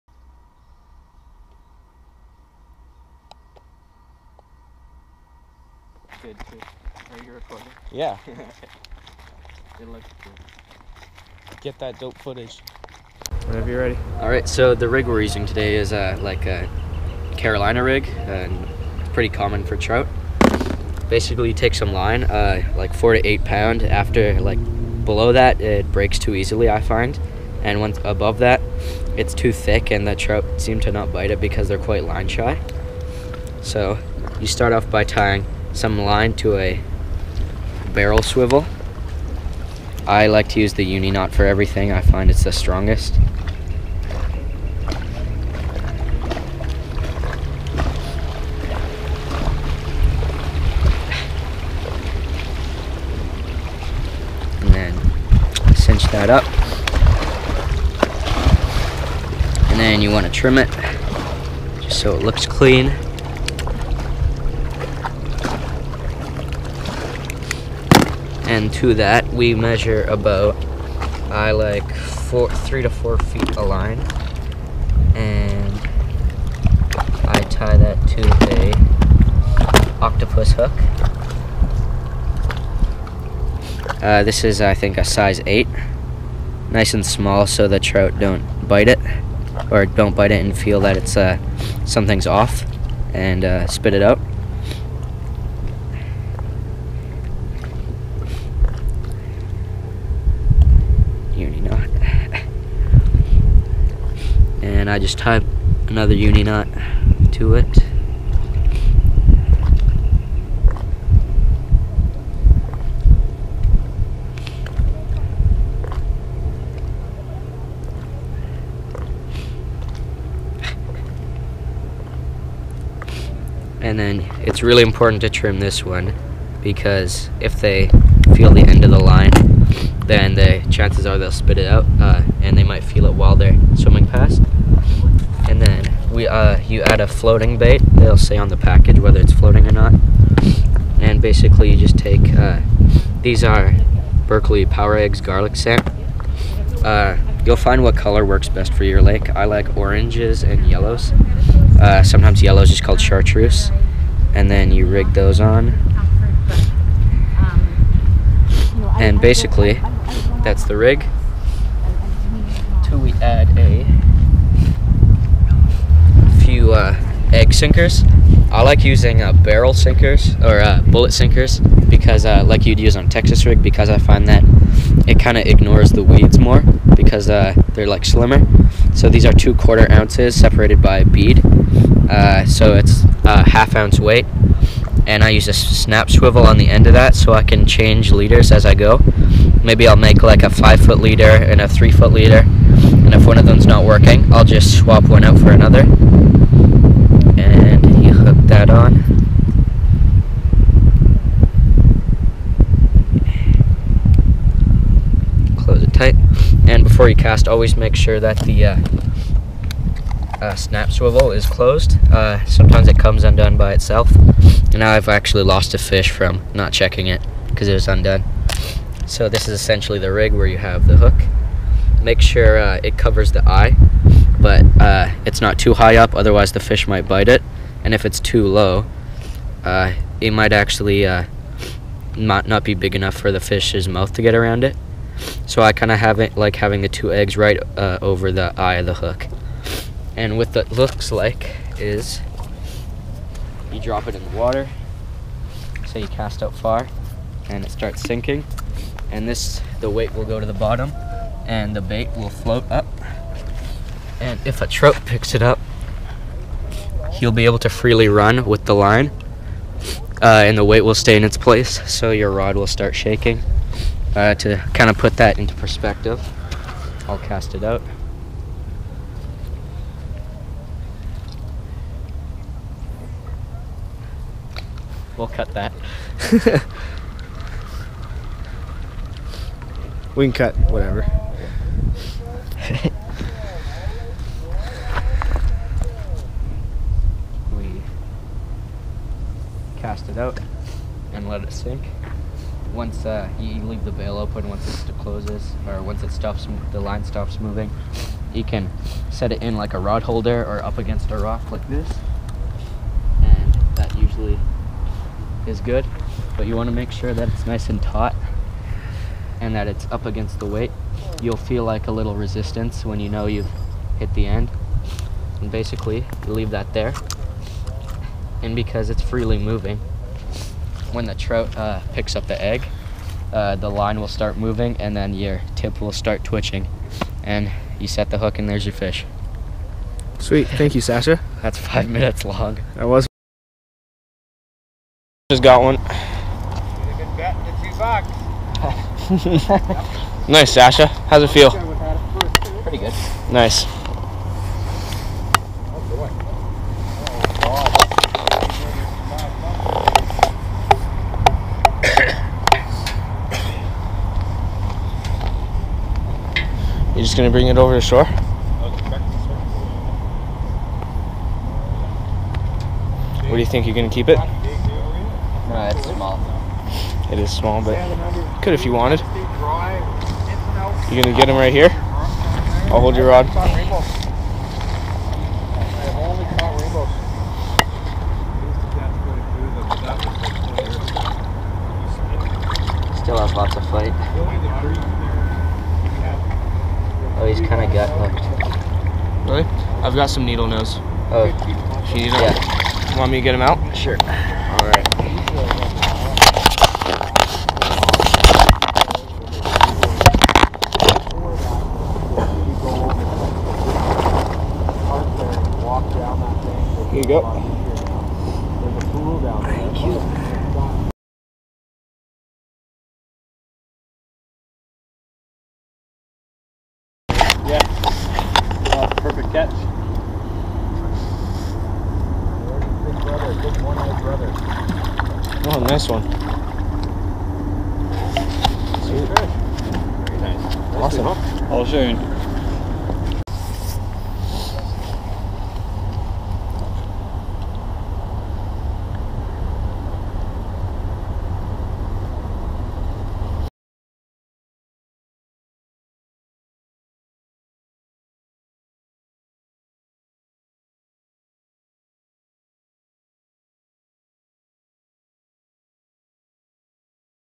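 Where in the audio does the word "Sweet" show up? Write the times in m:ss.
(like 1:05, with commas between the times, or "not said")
5:30, 7:08.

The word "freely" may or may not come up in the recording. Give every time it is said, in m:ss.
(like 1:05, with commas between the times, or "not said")
4:17, 5:19.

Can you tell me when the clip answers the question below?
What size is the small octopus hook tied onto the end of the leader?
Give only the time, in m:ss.
1:25.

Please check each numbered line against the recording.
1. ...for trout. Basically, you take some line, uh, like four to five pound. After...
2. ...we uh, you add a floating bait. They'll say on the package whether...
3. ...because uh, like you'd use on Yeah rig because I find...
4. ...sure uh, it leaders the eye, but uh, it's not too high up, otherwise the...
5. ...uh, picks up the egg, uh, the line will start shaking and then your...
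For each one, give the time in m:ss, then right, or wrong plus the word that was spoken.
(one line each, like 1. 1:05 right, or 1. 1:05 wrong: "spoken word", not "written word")
1. 0:19 wrong: "eight", not "five"
2. 2:16 right
3. 2:51 wrong: "Texas", not "Yeah"
4. 3:42 wrong: "covers", not "leaders"
5. 5:21 wrong: "moving", not "shaking".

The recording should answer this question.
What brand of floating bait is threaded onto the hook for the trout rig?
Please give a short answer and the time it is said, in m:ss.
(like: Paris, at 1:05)
Berkley Power Eggs, at 2:24.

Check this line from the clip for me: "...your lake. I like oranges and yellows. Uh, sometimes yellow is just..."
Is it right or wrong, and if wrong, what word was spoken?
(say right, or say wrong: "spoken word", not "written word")
right.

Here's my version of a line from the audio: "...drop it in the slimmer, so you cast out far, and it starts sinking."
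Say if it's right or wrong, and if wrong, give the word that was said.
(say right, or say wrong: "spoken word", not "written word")
wrong: "water", not "slimmer".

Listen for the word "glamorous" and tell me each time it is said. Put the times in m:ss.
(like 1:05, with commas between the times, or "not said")
not said.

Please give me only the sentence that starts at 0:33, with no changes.
So you start off by tying some line to a barrel swivel.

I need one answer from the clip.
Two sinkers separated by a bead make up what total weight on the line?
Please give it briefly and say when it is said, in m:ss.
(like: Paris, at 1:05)
half ounce, at 3:03.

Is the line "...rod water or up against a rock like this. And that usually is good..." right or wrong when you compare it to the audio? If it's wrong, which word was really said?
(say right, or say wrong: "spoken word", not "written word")
wrong: "holder", not "water".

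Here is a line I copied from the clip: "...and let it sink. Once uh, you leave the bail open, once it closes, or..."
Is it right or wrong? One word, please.
right.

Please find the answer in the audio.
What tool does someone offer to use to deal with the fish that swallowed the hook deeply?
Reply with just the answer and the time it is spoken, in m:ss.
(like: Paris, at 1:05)
needle nose, at 6:30.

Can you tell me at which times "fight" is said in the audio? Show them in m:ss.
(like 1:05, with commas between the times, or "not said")
6:23.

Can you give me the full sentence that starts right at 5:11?
You'll feel like a little resistance when you know you've hit the end.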